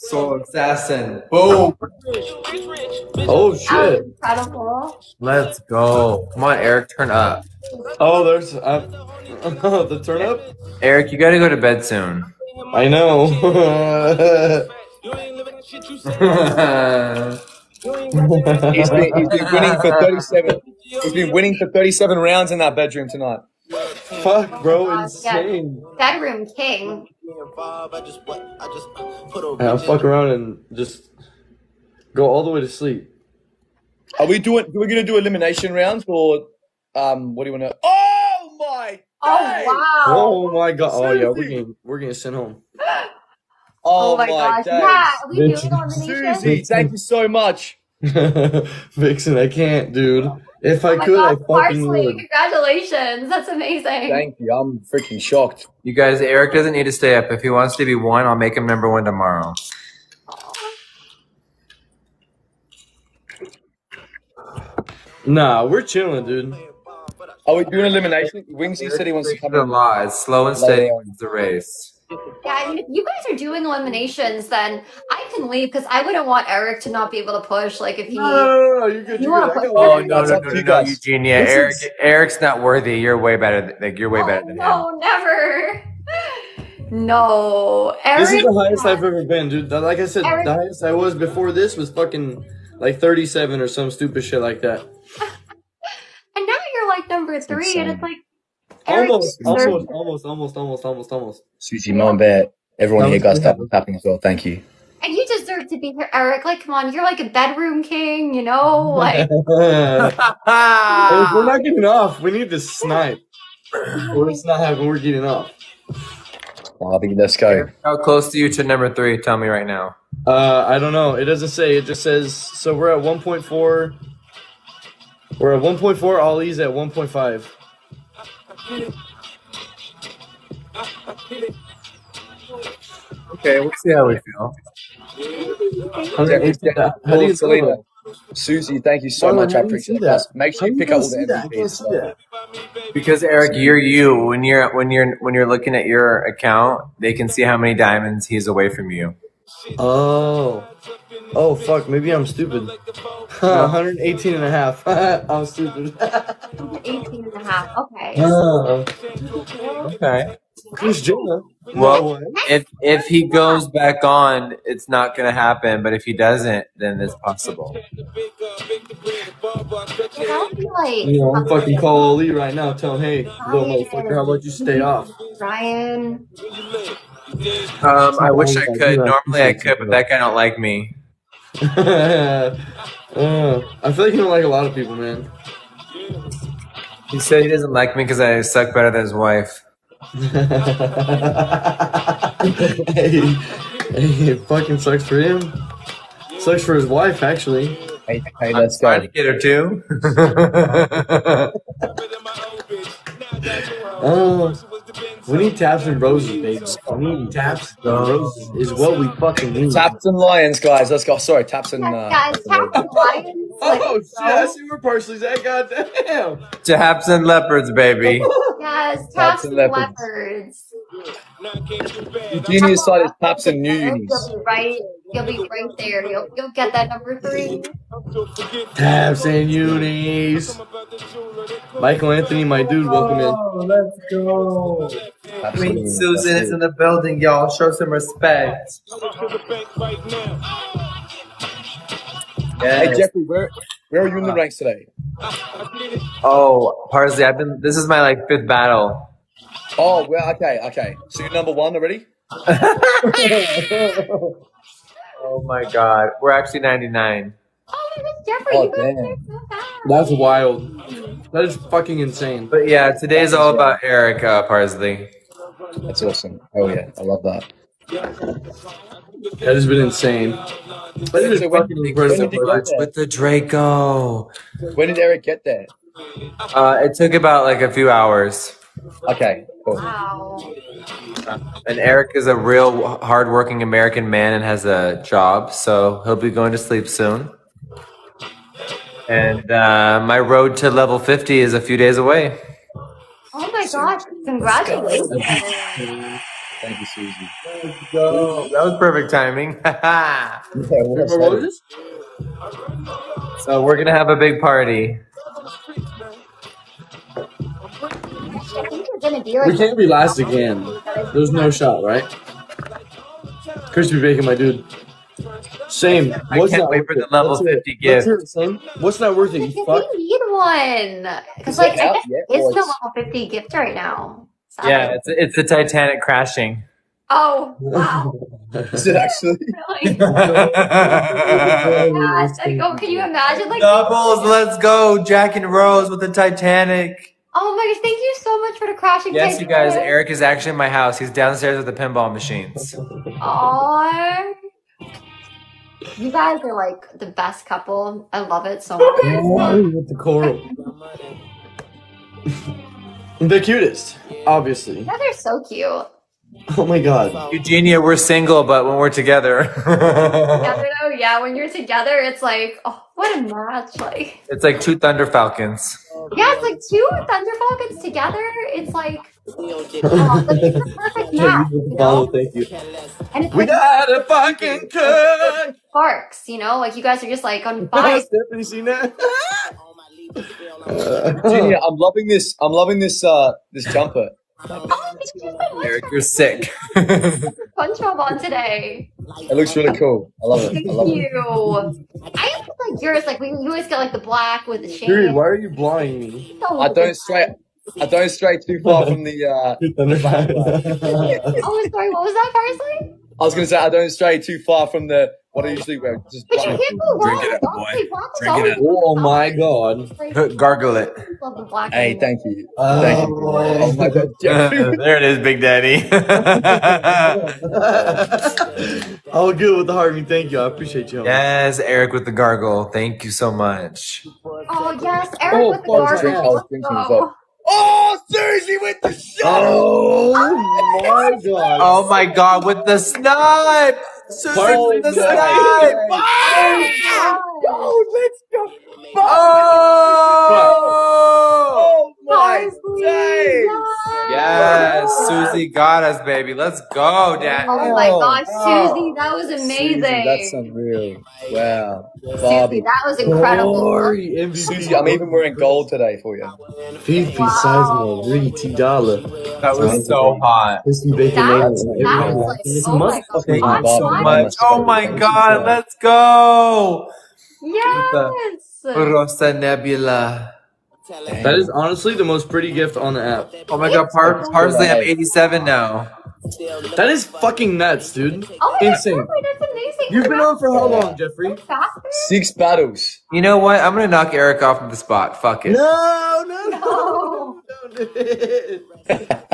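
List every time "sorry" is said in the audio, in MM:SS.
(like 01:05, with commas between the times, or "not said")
03:31, 06:41.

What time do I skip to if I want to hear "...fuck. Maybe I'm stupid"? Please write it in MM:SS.
02:31.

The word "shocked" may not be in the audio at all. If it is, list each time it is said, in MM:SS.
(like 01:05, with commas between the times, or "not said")
00:55.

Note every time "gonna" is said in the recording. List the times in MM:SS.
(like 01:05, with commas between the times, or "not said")
00:34, 02:45, 08:03.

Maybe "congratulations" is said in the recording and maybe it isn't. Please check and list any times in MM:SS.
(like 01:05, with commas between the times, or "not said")
00:52, 04:54.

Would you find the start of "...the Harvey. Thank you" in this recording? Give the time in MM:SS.
06:59.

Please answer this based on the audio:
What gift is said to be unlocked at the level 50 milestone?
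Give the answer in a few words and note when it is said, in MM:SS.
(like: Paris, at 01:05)
The Titanic crashing, at 05:25.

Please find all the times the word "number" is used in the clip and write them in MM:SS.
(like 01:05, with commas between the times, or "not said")
00:58, 01:37, 01:58, 03:46, 04:11.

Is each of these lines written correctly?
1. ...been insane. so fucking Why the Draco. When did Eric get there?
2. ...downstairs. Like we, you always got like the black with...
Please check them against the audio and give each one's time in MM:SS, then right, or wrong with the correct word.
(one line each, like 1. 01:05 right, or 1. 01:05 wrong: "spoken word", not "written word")
1. 04:29 wrong: "With", not "Why"
2. 06:32 wrong: "yours", not "downstairs".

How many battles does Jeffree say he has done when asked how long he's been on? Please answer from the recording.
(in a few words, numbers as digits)
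6.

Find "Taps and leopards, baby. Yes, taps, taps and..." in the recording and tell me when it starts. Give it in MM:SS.
03:36.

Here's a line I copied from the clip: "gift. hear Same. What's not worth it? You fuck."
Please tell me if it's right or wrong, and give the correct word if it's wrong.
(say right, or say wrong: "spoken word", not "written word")
right.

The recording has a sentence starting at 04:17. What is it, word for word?
Oh, my was Jeffree, oh, so That's wild.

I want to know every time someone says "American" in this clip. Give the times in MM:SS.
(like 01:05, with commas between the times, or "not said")
04:43.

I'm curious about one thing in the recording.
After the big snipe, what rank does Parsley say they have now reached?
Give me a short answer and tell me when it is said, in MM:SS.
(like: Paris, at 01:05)
87, at 07:54.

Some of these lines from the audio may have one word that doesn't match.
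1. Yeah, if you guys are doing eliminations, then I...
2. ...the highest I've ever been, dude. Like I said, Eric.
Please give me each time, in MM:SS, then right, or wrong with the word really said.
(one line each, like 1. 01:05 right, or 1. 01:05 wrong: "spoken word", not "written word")
1. 01:12 right
2. 01:28 right.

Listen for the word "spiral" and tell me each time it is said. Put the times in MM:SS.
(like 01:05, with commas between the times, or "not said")
not said.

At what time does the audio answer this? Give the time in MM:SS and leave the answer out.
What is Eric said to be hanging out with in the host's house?
05:41.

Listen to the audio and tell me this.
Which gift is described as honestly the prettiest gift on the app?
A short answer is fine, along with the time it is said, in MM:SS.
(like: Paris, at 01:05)
Rosa Nebula, at 07:48.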